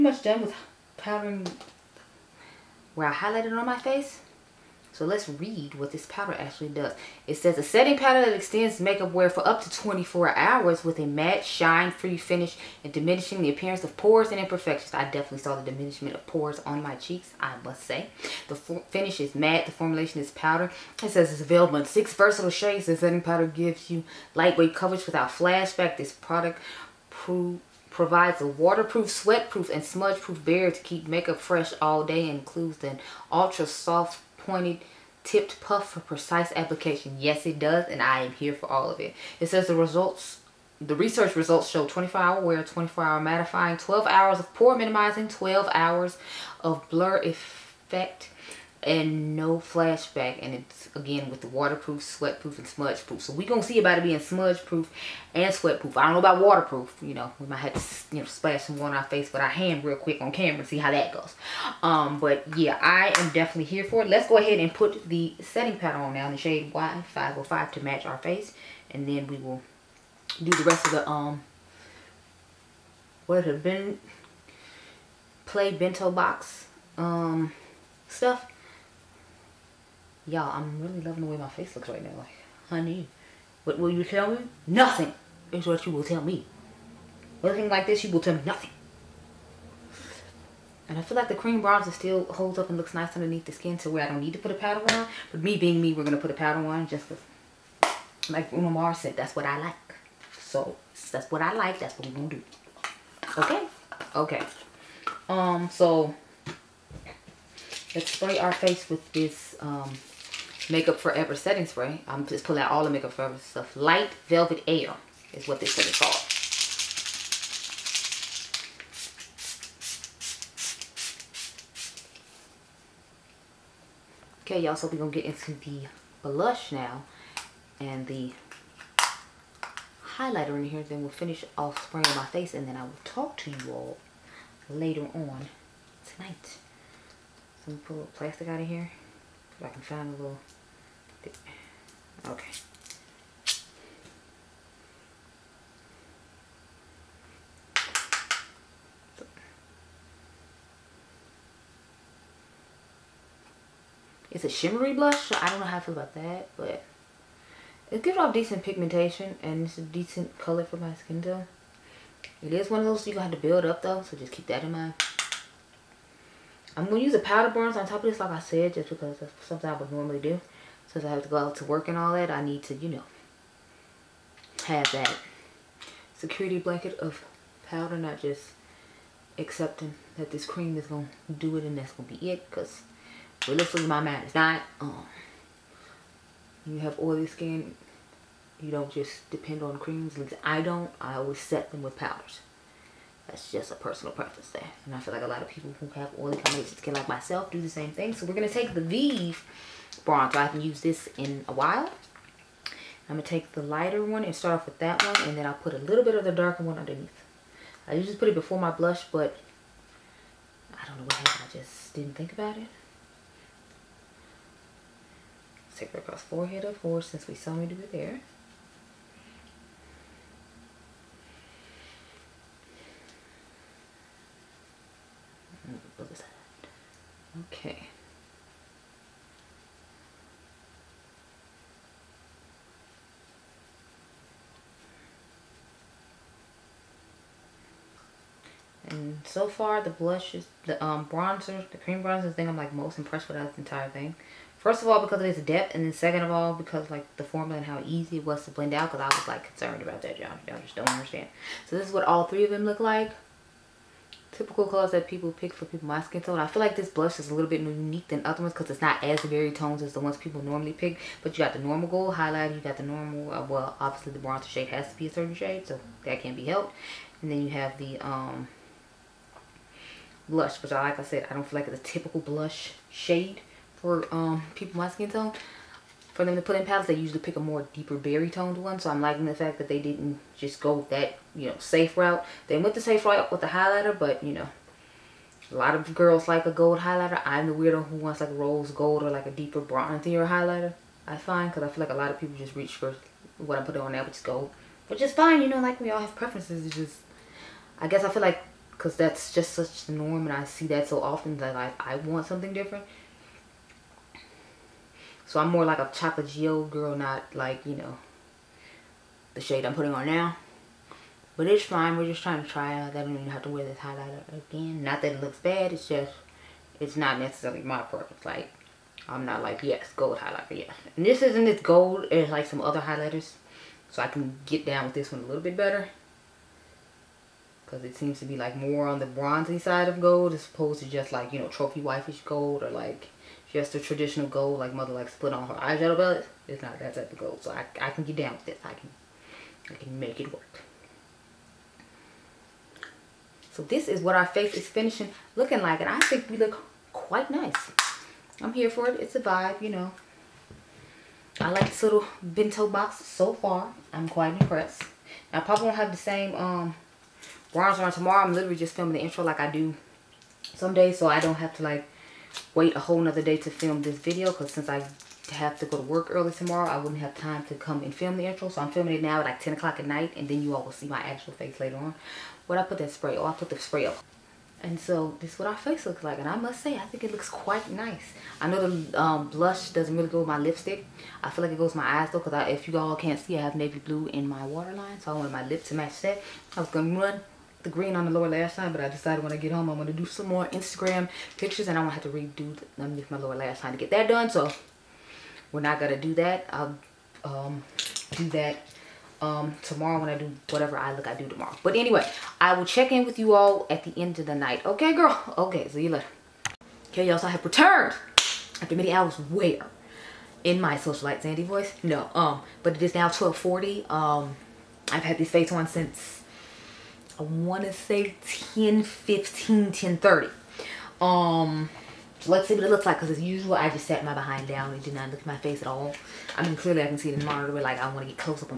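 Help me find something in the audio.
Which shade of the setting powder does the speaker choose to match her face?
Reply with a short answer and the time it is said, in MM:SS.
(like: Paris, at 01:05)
Y505, at 01:06.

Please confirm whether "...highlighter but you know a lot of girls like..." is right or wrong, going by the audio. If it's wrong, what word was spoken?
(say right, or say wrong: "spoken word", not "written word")
right.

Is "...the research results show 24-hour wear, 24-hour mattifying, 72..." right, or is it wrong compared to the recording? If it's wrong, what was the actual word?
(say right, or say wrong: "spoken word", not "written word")
wrong: "12", not "72".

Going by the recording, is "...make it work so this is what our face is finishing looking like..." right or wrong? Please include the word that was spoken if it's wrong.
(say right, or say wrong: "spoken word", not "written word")
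right.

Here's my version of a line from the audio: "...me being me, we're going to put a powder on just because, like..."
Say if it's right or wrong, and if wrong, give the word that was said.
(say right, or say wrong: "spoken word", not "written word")
right.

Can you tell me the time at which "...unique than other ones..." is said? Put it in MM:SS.
04:17.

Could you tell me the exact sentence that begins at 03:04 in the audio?
Um, you have oily skin, you don't just depend on creams.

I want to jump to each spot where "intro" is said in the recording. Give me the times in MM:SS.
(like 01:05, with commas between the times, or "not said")
05:58, 06:08.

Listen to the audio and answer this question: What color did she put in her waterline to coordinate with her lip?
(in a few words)
Navy blue.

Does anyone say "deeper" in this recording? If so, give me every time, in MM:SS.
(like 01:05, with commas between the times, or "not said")
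04:37, 04:49.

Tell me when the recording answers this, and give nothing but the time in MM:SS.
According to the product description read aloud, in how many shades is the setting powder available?
00:21.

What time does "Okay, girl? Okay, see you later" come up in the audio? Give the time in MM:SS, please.
06:44.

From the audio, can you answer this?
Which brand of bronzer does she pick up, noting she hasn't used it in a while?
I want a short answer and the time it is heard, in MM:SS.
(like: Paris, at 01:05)
Vive, at 03:18.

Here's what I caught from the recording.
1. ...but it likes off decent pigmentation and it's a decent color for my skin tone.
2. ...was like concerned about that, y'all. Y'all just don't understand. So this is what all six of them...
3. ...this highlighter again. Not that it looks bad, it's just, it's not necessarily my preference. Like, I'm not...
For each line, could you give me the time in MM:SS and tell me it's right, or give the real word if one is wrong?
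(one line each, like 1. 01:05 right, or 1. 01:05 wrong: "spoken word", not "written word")
1. 02:36 wrong: "gives", not "likes"
2. 04:09 wrong: "three", not "six"
3. 05:13 right.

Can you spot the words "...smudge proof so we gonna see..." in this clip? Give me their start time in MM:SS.
00:52.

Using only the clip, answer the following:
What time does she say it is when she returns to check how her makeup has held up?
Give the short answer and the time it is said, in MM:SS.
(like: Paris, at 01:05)
12:40, at 06:53.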